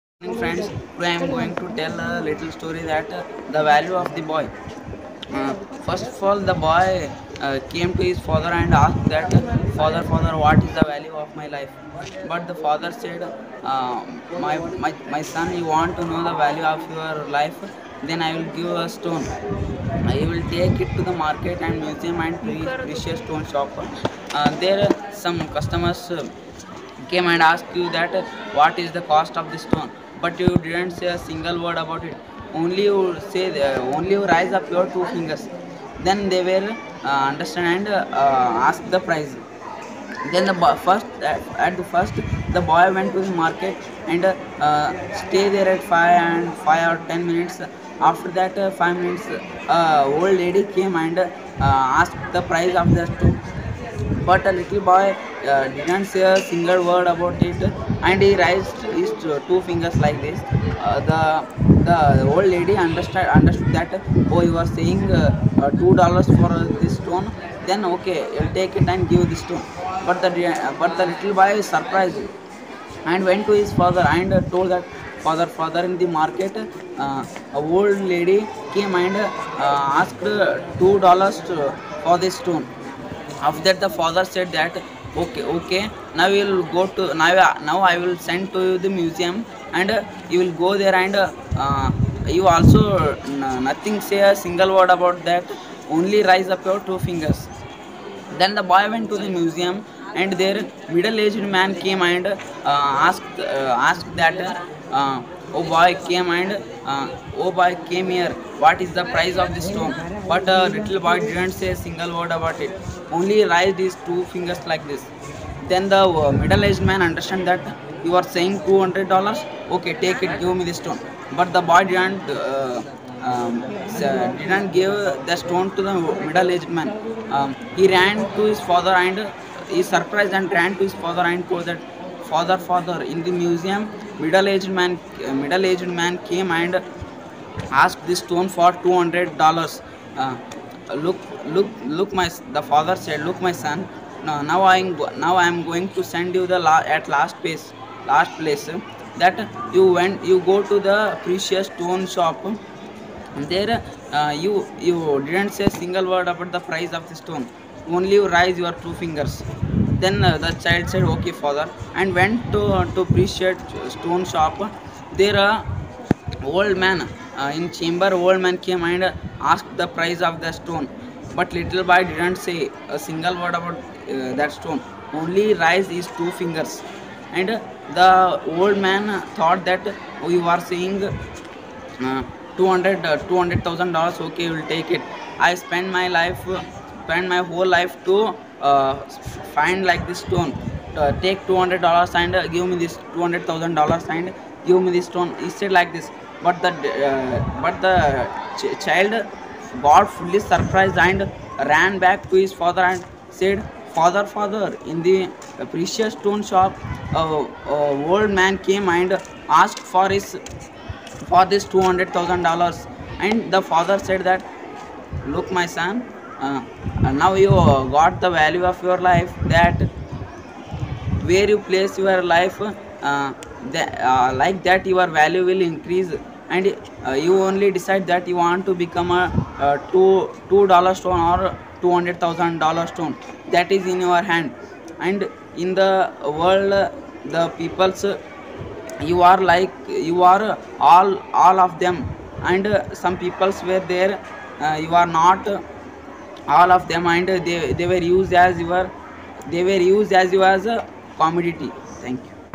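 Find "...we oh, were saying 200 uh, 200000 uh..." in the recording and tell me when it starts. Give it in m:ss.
3:00.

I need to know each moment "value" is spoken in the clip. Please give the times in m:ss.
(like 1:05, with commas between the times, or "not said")
0:03, 0:10, 0:16, 3:38, 3:45.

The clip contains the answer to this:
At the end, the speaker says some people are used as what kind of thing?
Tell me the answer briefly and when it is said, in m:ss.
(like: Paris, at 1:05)
a commodity, at 4:11.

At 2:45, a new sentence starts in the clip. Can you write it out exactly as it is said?
There a old man uh, in chamber old man came and asked the price of the stone.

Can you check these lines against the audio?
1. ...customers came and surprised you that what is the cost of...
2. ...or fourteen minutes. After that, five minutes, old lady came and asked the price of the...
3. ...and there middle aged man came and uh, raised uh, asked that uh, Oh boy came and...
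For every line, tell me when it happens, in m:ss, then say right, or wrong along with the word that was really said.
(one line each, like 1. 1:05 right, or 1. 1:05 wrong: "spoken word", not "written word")
1. 0:25 wrong: "asked", not "surprised"
2. 0:46 wrong: "ten", not "fourteen"
3. 1:40 wrong: "asked", not "raised".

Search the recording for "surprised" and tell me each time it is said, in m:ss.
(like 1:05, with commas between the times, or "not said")
1:11, 2:09, 3:20.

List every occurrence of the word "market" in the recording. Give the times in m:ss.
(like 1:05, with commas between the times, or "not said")
0:21, 0:43, 1:16.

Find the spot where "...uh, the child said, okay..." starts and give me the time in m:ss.
2:40.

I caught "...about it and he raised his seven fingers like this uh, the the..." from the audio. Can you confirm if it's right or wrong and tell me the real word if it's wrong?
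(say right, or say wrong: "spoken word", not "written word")
wrong: "two", not "seven".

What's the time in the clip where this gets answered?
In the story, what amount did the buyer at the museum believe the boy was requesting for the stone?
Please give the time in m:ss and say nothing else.
1:58.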